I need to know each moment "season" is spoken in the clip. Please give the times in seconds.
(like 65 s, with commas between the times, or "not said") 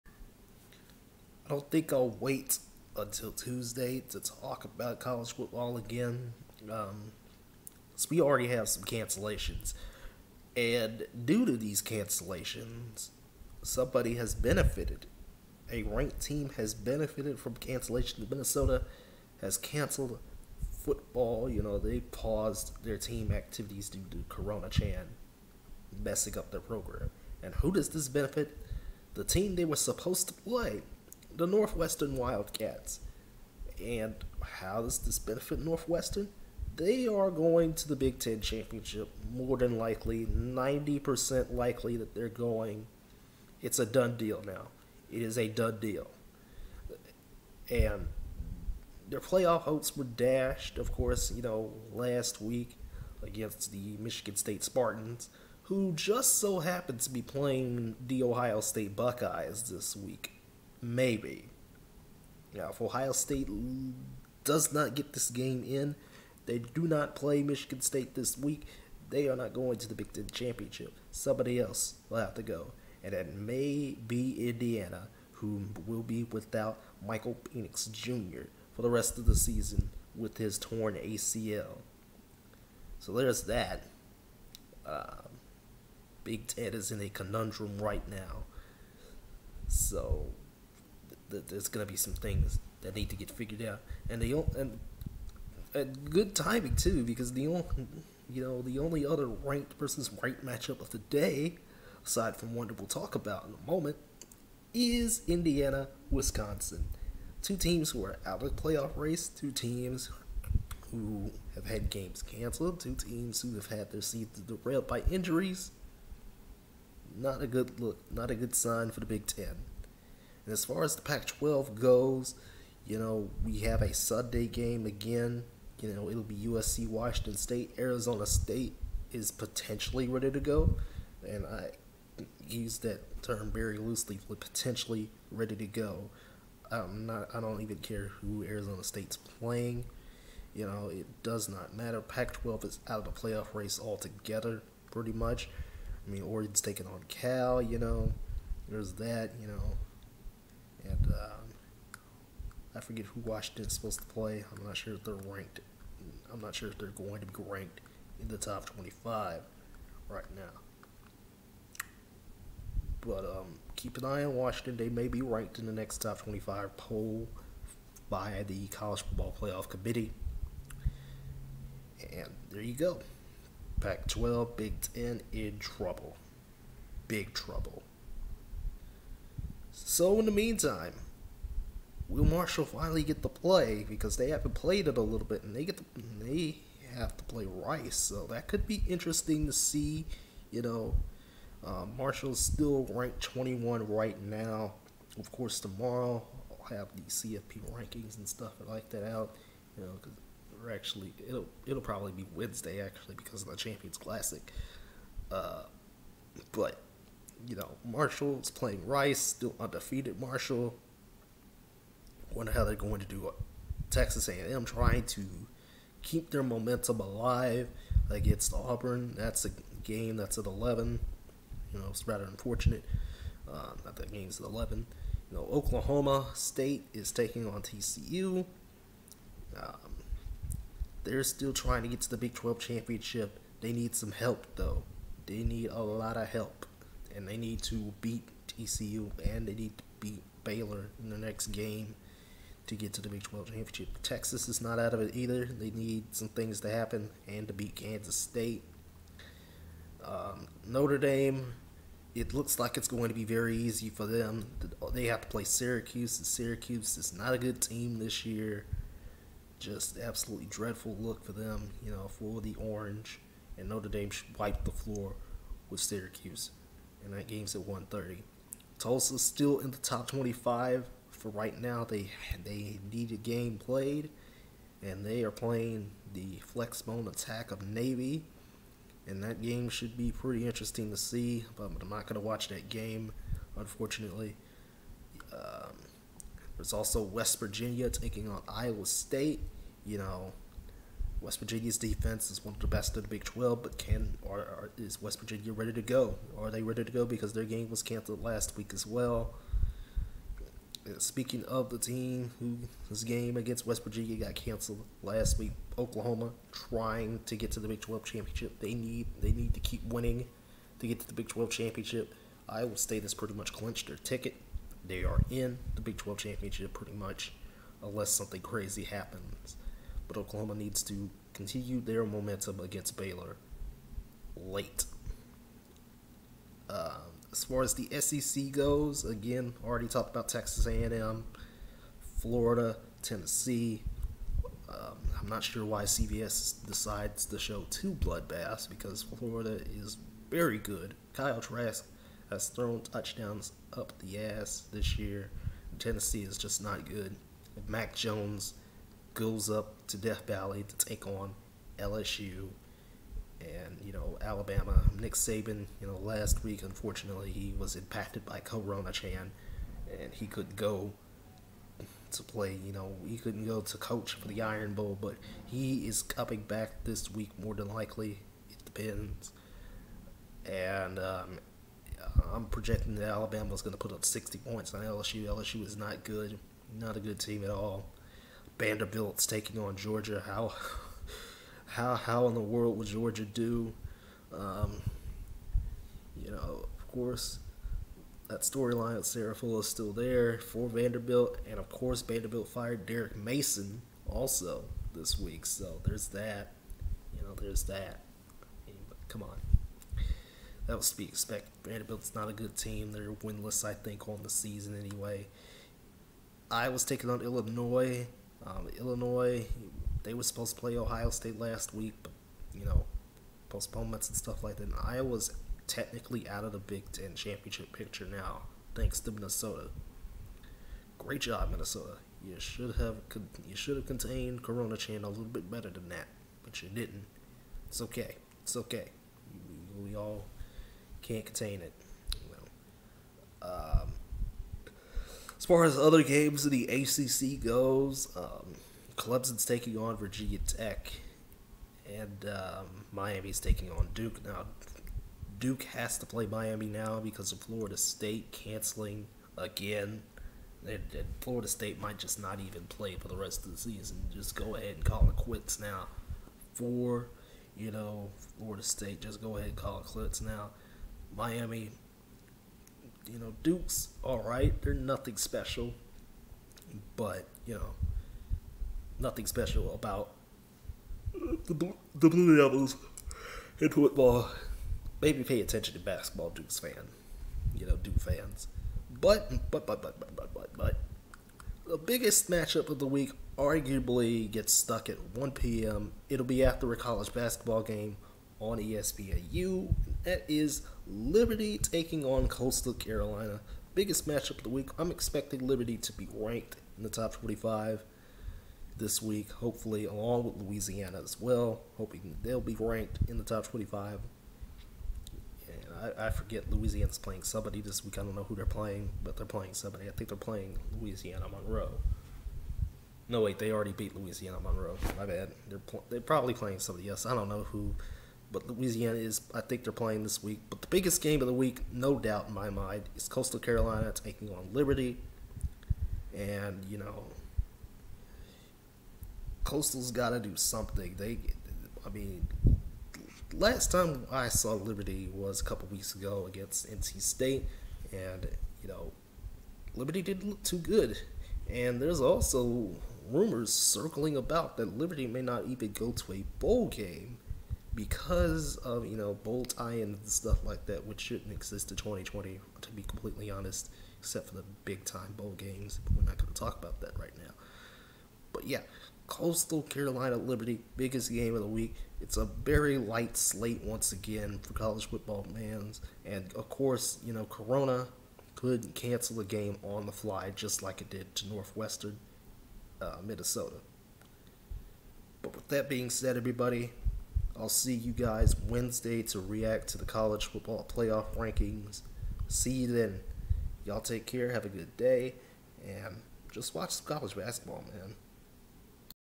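79 s, 114 s, 404 s, 453 s.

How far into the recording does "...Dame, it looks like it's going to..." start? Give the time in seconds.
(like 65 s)
250 s.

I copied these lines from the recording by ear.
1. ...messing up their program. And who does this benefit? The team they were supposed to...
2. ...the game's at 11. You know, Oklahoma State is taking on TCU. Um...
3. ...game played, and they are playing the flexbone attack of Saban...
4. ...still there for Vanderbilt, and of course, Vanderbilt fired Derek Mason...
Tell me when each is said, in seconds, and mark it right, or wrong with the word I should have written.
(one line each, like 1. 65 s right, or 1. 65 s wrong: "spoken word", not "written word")
1. 26 s right
2. 223 s right
3. 273 s wrong: "Navy", not "Saban"
4. 389 s right.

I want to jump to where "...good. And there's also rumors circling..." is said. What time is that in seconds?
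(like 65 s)
540 s.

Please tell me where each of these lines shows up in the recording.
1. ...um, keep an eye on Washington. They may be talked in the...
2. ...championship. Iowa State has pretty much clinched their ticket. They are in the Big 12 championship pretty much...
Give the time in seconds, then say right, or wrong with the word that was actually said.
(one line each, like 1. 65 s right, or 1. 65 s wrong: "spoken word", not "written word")
1. 163 s wrong: "ranked", not "talked"
2. 311 s right.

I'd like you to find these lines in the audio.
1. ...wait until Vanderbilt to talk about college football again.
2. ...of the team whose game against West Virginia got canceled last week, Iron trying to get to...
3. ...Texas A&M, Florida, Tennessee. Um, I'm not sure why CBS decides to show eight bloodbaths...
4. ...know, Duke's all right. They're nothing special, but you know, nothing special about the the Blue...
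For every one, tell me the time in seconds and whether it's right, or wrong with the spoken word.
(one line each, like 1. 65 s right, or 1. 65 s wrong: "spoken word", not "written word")
1. 2 s wrong: "Tuesday", not "Vanderbilt"
2. 301 s wrong: "Oklahoma", not "Iron"
3. 330 s wrong: "two", not "eight"
4. 463 s right.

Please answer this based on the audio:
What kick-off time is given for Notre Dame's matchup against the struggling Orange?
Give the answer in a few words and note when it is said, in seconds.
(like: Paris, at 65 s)
1:30, at 267 s.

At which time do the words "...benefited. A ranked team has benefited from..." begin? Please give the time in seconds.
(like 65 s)
14 s.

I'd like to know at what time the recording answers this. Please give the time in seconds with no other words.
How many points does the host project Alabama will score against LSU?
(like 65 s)
374 s.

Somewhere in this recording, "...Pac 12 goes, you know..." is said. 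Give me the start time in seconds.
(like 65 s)
121 s.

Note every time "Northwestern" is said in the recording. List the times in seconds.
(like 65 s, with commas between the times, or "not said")
31 s, 35 s, 571 s.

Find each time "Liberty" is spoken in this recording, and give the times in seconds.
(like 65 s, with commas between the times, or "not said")
490 s, 495 s, 524 s, 534 s, 539 s, 544 s, 560 s.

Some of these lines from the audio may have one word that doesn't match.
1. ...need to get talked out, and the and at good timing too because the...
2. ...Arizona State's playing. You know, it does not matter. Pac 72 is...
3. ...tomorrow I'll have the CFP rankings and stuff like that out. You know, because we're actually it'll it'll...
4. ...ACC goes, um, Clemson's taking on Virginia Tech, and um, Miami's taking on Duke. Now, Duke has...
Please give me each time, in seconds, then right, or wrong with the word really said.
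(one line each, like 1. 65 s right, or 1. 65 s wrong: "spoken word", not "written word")
1. 92 s wrong: "figured", not "talked"
2. 138 s wrong: "12", not "72"
3. 195 s right
4. 436 s right.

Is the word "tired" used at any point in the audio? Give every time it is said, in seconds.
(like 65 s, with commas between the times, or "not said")
not said.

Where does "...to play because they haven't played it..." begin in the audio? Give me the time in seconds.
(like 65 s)
183 s.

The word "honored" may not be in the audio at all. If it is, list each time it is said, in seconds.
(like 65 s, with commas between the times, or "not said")
not said.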